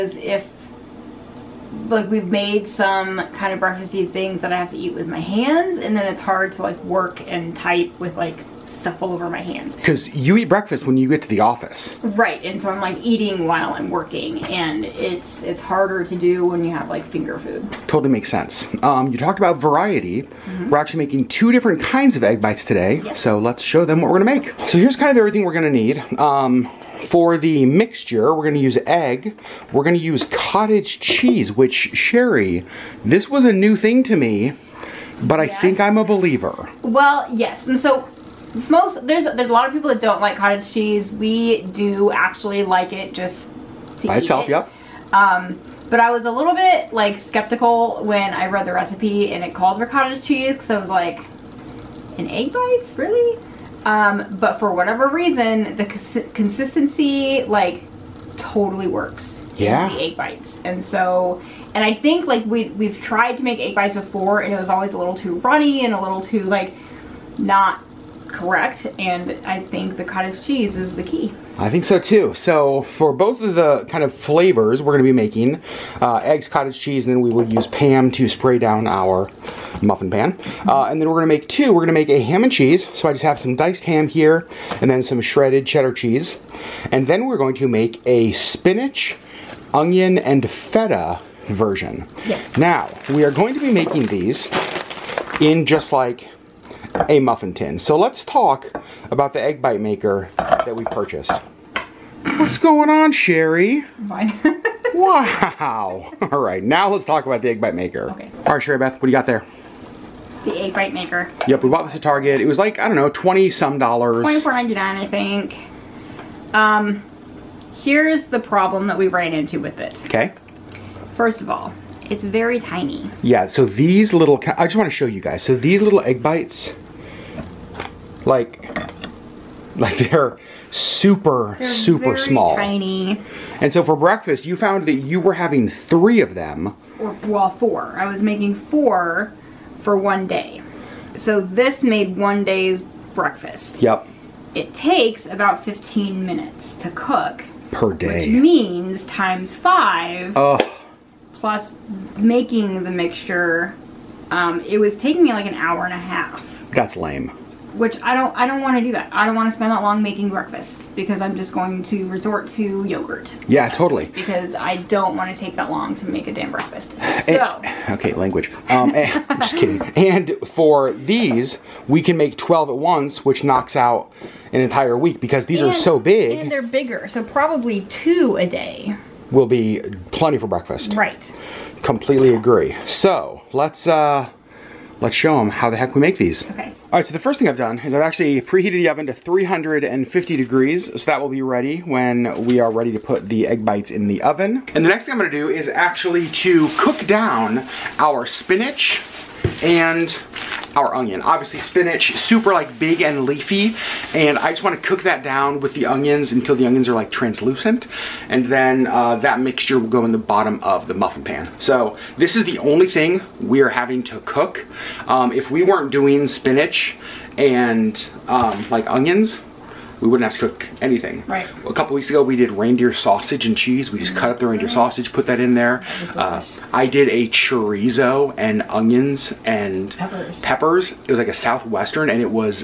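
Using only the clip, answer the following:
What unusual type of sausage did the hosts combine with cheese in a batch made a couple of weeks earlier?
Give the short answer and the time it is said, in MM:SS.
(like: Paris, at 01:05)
reindeer sausage, at 03:42.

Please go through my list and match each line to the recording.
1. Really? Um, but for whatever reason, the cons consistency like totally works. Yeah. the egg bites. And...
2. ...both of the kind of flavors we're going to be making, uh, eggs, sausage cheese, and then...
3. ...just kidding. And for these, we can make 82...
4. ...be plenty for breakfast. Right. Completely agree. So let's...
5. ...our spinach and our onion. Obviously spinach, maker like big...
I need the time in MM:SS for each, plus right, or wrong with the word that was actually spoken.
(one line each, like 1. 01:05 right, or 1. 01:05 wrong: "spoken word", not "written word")
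1. 00:52 right
2. 01:13 wrong: "cottage", not "sausage"
3. 02:49 wrong: "12", not "82"
4. 02:59 right
5. 03:17 wrong: "super", not "maker".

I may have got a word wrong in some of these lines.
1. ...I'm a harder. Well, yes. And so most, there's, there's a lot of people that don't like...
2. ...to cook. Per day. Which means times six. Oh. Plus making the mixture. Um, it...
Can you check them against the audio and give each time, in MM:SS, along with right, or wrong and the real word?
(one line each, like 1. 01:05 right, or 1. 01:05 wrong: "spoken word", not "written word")
1. 00:35 wrong: "believer", not "harder"
2. 02:26 wrong: "five", not "six".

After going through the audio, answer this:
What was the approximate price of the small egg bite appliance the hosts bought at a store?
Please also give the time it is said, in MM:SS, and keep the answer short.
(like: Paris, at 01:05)
$24.99, at 01:54.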